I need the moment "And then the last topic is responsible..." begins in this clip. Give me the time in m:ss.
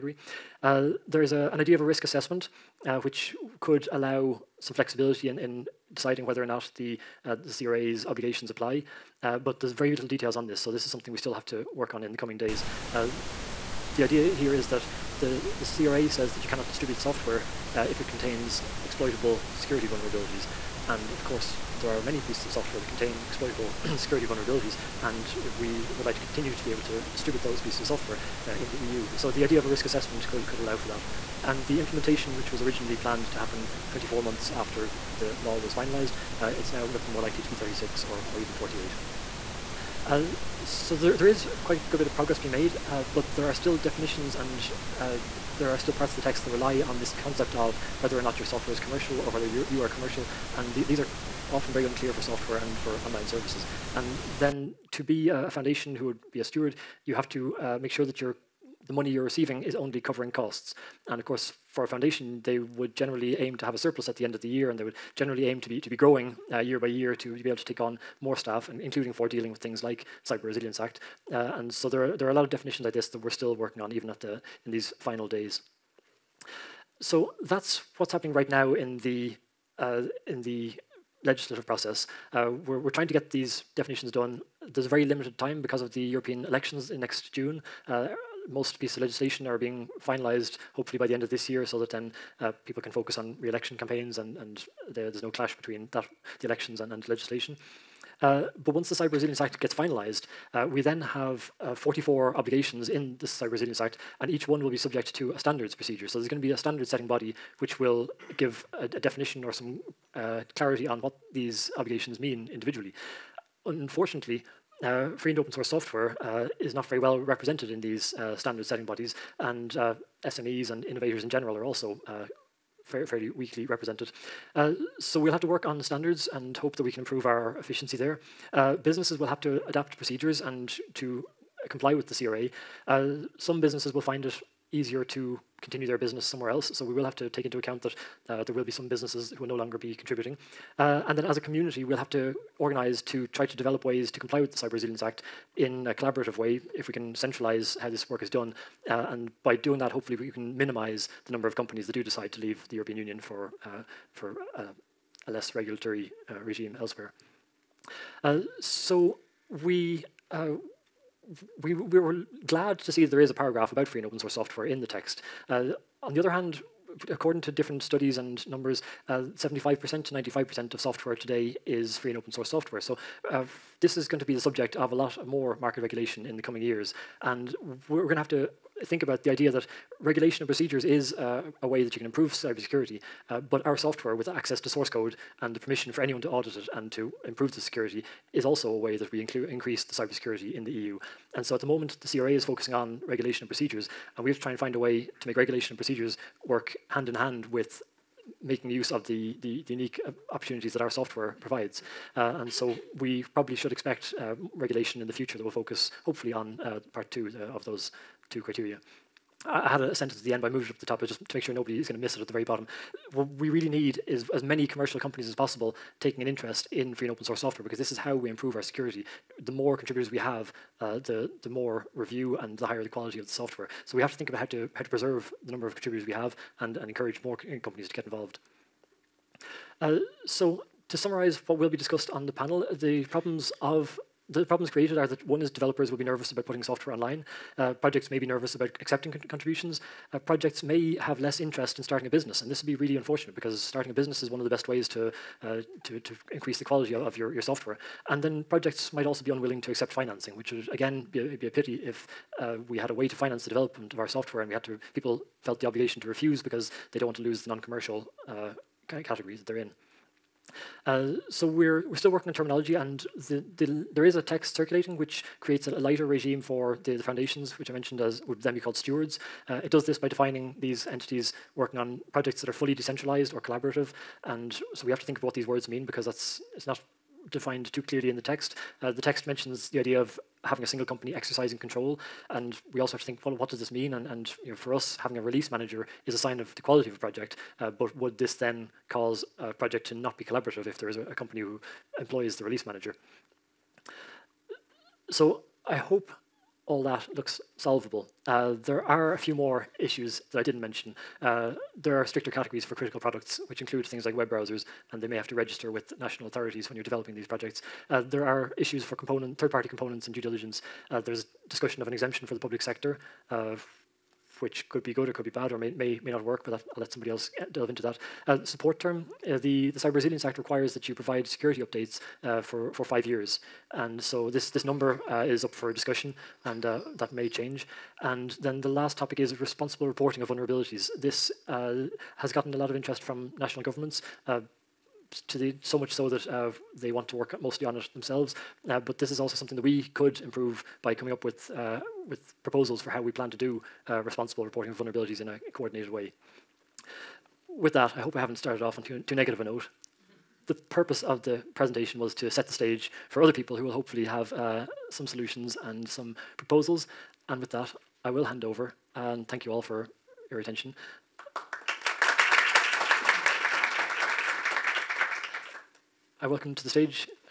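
5:28.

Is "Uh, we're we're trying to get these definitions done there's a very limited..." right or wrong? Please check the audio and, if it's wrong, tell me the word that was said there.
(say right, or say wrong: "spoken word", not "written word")
right.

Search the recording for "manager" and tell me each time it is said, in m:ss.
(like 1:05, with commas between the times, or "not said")
4:45, 4:52.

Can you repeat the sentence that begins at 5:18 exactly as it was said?
Uh, support term, uh, the, the Cyber Resilience Act requires that you provide security updates uh, for, for five years.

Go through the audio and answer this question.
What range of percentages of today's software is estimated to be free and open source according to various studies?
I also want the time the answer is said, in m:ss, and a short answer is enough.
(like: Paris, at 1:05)
75% to 95%, at 2:49.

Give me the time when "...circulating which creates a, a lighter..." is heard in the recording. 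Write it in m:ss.
4:24.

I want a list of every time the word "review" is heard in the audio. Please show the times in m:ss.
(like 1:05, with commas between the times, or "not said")
3:41.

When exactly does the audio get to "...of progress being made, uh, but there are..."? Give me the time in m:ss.
0:42.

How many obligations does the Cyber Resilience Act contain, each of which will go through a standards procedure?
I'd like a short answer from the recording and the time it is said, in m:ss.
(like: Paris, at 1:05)
44, at 1:41.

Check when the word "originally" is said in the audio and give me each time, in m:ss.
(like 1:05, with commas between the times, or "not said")
0:32.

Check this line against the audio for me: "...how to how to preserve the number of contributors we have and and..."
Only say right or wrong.
right.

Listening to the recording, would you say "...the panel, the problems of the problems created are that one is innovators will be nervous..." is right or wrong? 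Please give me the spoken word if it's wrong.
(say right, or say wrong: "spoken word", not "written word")
wrong: "developers", not "innovators".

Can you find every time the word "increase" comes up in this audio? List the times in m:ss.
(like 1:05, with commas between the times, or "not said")
3:09, 4:06.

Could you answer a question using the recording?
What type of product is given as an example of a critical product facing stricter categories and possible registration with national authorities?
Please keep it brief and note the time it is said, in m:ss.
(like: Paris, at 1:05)
web browsers, at 5:04.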